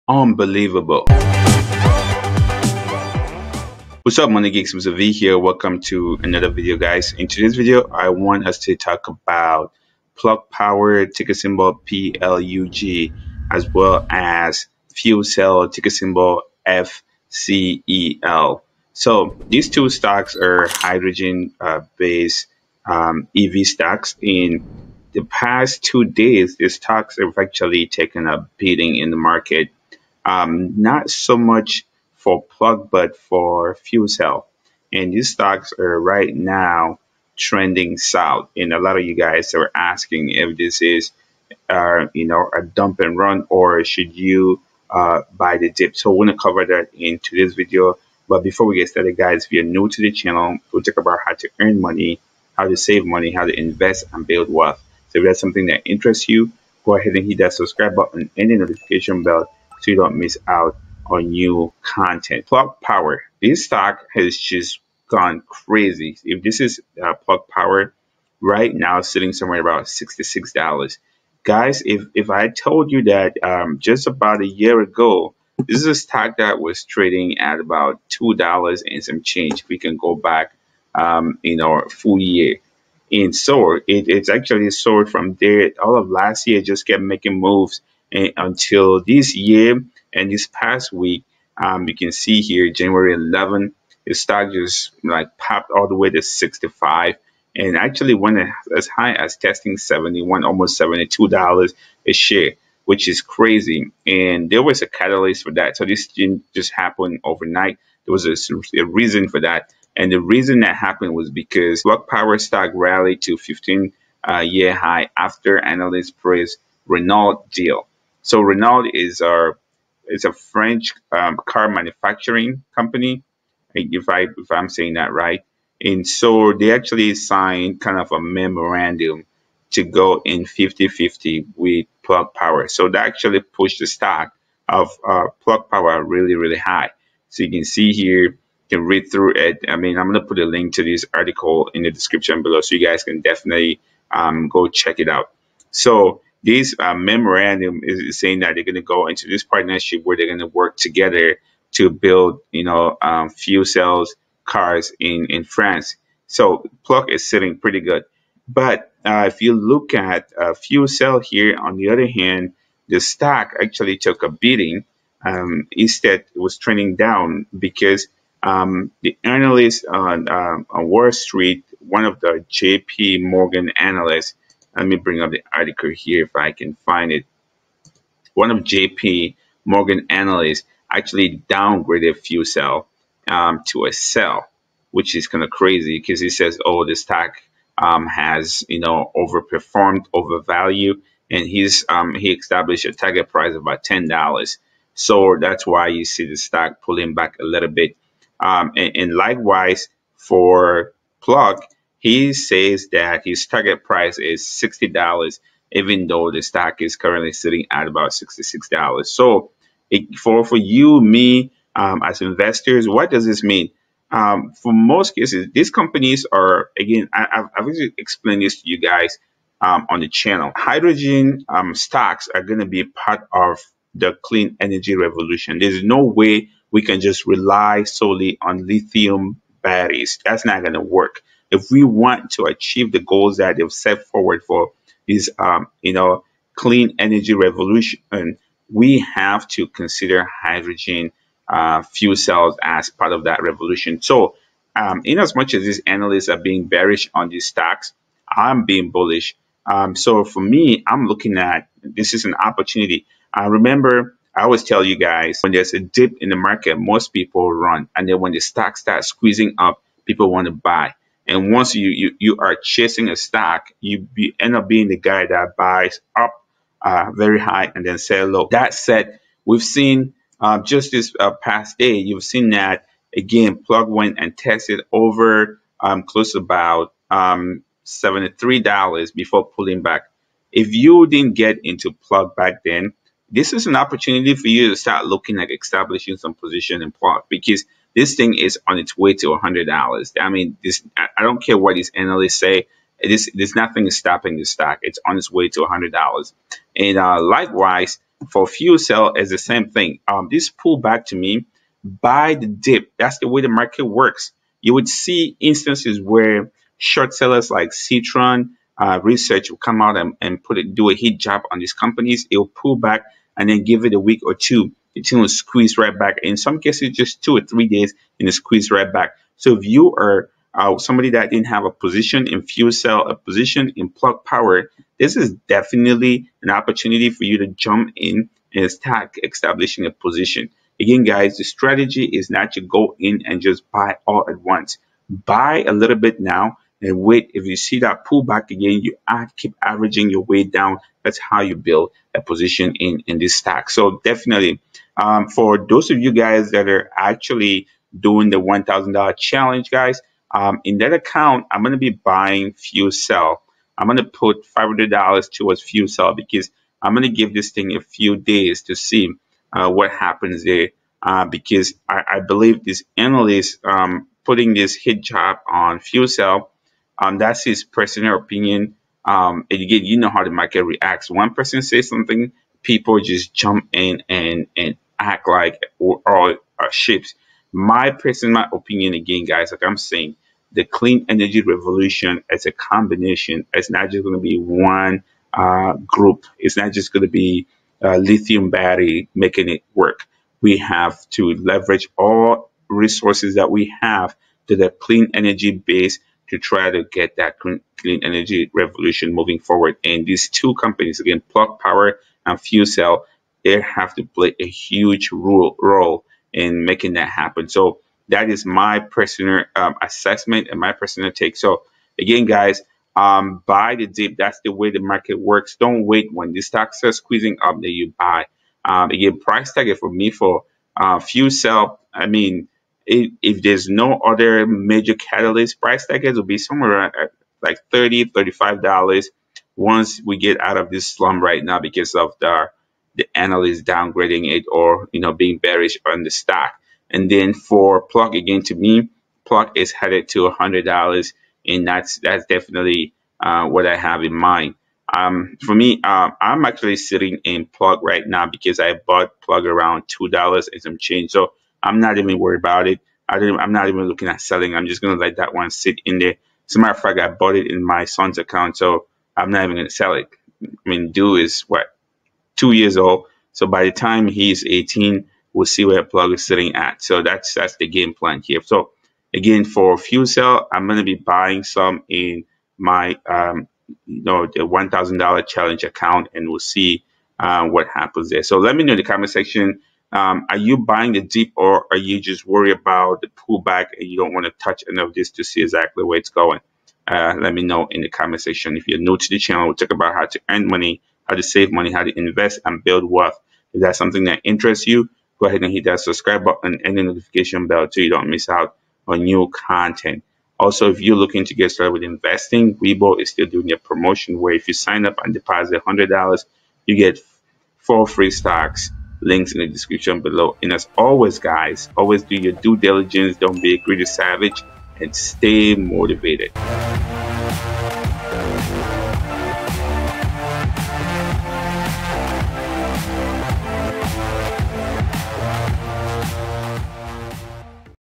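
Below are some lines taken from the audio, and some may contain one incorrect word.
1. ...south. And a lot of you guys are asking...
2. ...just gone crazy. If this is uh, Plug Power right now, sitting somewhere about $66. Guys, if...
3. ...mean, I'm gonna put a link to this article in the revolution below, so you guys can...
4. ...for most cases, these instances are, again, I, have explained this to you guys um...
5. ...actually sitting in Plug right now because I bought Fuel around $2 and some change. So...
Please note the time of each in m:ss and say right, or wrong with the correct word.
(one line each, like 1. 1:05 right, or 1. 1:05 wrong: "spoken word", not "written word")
1. 0:37 right
2. 1:04 right
3. 2:19 wrong: "description", not "revolution"
4. 3:34 wrong: "companies", not "instances"
5. 7:26 wrong: "Plug", not "Fuel".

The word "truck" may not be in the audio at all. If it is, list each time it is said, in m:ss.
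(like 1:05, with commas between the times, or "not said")
not said.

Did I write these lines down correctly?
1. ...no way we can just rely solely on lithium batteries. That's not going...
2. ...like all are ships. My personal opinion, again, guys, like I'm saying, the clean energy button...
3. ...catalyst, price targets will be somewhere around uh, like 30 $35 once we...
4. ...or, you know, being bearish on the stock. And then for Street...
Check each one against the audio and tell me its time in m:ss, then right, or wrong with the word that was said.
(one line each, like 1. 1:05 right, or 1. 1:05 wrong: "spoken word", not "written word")
1. 3:45 right
2. 6:15 wrong: "revolution", not "button"
3. 7:04 right
4. 7:14 wrong: "Plug", not "Street".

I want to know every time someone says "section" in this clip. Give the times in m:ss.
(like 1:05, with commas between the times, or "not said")
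7:59, 8:08.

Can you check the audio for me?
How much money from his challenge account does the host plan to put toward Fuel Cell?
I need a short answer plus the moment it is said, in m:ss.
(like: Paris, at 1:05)
$500, at 5:54.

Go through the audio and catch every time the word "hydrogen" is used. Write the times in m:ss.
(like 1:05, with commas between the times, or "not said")
0:20, 3:40, 4:00.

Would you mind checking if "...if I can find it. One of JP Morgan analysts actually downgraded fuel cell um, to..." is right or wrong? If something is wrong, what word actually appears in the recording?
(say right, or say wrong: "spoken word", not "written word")
right.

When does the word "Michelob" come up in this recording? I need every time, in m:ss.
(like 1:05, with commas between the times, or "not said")
not said.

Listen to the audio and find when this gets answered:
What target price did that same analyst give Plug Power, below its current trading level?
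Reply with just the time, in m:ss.
3:24.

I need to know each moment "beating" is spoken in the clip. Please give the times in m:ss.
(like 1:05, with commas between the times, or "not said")
0:28, 2:44.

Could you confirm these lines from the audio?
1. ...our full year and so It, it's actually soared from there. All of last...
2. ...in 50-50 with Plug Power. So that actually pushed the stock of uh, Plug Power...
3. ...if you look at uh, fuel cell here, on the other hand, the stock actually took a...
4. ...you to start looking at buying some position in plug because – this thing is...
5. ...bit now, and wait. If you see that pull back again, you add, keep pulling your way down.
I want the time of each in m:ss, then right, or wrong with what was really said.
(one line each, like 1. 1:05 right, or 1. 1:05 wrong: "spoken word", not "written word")
1. 1:21 right
2. 2:10 right
3. 2:39 right
4. 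4:44 wrong: "establishing", not "buying"
5. 5:35 wrong: "averaging", not "pulling".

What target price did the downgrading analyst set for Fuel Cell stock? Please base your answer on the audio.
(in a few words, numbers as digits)
$10.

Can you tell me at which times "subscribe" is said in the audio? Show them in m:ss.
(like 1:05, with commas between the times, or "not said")
0:57, 8:15.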